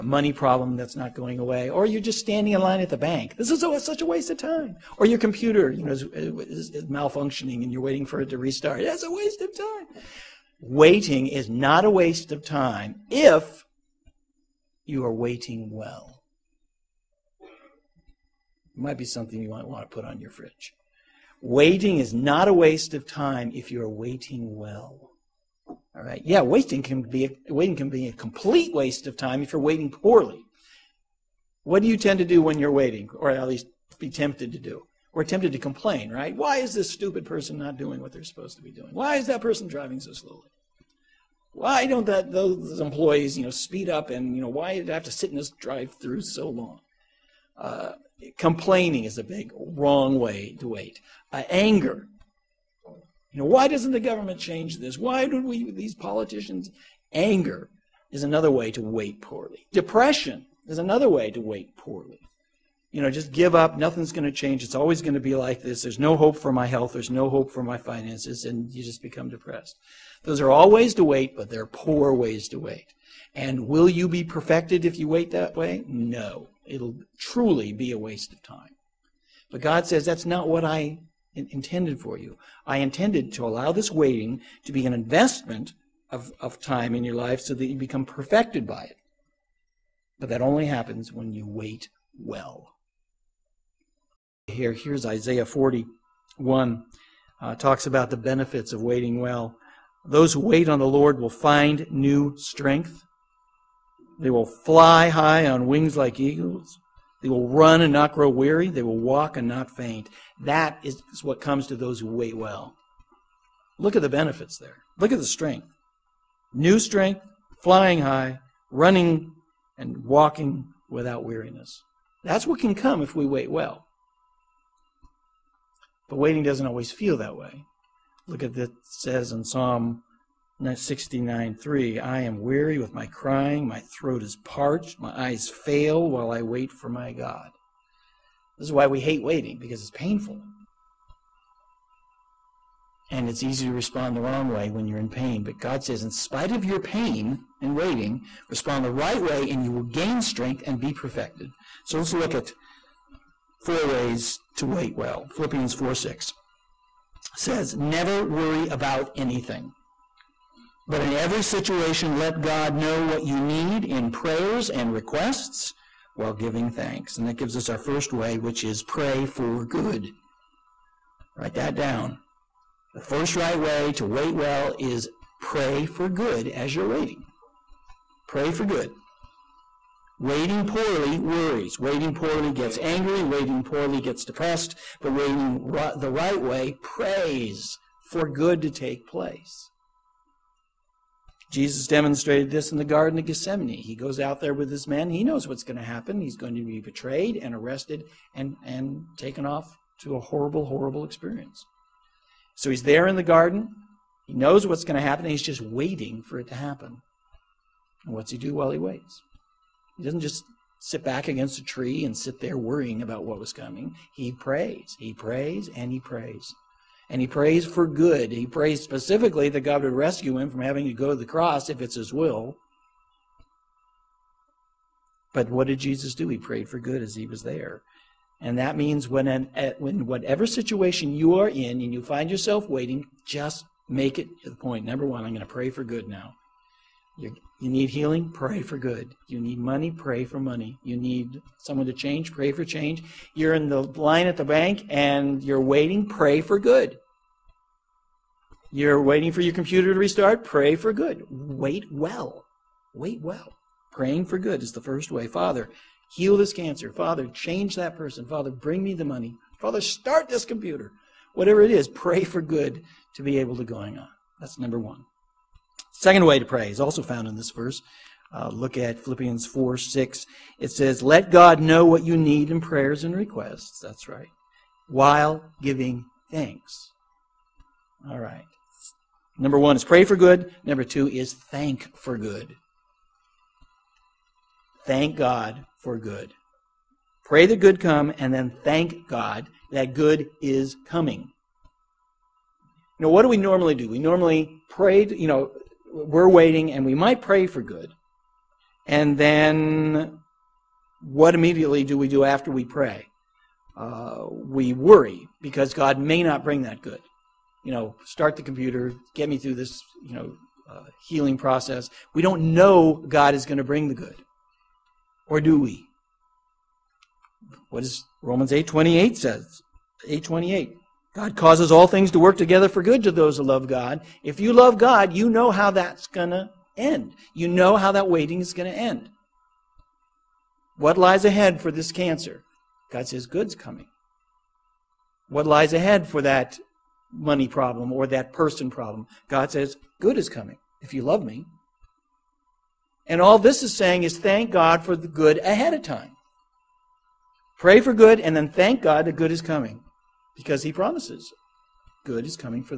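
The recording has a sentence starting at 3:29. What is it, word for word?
He doesn't just sit back against a tree and sit there worrying about what was coming.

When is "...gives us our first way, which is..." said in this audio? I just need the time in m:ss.
2:47.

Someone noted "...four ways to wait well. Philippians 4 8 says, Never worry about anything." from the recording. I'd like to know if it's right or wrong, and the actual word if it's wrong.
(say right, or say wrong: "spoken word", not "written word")
wrong: "6", not "8".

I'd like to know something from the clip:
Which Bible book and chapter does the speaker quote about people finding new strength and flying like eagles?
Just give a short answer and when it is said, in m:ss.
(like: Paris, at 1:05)
Isaiah 41, at 1:35.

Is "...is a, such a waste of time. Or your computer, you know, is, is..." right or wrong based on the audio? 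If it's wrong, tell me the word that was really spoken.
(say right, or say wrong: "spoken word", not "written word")
right.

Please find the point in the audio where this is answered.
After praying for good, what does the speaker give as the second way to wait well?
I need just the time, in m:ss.
4:41.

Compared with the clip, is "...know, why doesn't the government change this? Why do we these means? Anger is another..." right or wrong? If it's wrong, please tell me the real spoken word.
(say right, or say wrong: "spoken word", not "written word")
wrong: "politicians", not "means".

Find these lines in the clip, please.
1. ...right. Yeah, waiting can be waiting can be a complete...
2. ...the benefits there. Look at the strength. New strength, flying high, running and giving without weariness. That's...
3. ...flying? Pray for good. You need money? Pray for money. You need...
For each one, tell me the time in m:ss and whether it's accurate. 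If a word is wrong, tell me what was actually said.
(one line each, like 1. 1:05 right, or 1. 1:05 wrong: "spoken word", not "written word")
1. 0:26 right
2. 1:54 wrong: "walking", not "giving"
3. 3:57 wrong: "healing", not "flying".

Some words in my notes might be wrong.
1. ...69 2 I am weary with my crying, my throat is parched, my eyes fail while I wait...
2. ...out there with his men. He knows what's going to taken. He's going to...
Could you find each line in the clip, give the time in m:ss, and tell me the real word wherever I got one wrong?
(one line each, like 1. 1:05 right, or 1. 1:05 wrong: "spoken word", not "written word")
1. 2:10 wrong: "3", not "2"
2. 3:14 wrong: "happen", not "taken".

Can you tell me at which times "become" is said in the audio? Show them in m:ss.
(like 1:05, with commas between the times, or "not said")
1:09, 1:27.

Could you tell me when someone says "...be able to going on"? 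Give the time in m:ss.
4:23.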